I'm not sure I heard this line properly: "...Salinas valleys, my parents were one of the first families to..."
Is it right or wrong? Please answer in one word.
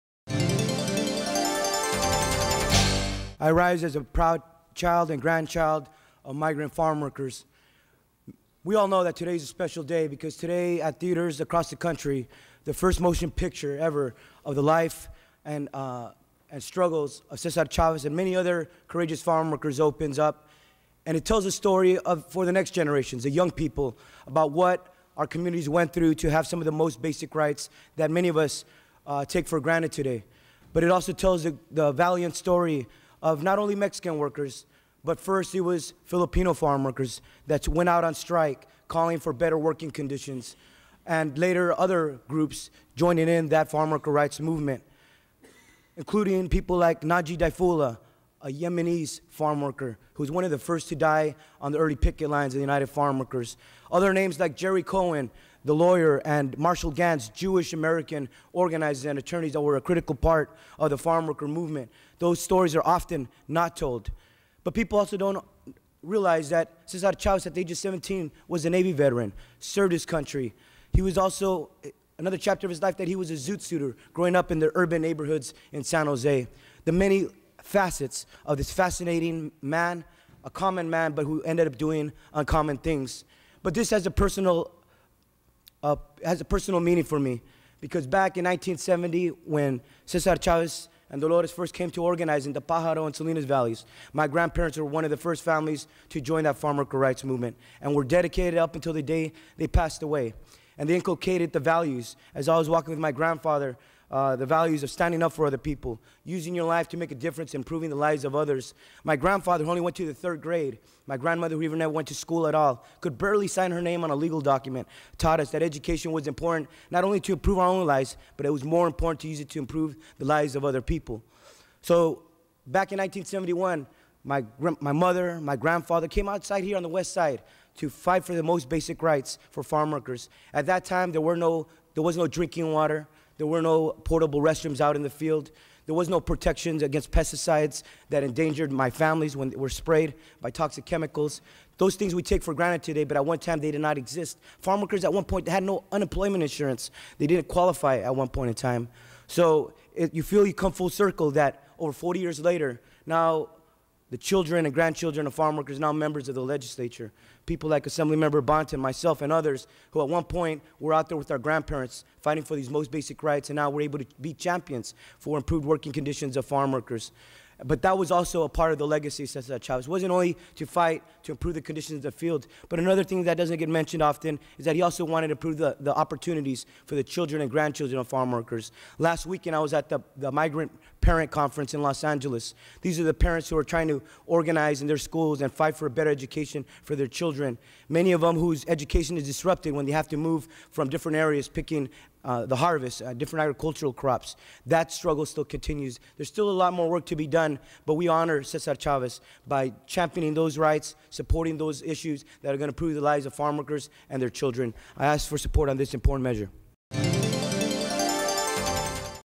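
wrong.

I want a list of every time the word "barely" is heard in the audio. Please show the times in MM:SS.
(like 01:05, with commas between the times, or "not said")
01:53.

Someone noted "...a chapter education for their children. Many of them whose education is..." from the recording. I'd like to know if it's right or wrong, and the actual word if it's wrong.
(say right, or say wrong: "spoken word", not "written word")
wrong: "better", not "chapter".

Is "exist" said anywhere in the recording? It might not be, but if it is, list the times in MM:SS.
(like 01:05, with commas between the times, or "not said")
02:23.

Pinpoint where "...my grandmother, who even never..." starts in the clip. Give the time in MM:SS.
01:51.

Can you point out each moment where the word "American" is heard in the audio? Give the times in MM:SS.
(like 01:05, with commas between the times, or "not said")
00:57.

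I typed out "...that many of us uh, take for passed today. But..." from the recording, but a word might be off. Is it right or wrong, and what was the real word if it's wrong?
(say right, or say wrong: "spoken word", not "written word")
wrong: "granted", not "passed".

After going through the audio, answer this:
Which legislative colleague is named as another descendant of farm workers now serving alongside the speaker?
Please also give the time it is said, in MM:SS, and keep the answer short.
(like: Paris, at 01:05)
Assemblymember Bonta, at 02:37.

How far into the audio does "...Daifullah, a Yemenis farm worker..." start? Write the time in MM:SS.
00:47.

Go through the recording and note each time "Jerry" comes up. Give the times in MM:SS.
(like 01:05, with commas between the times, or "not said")
00:54.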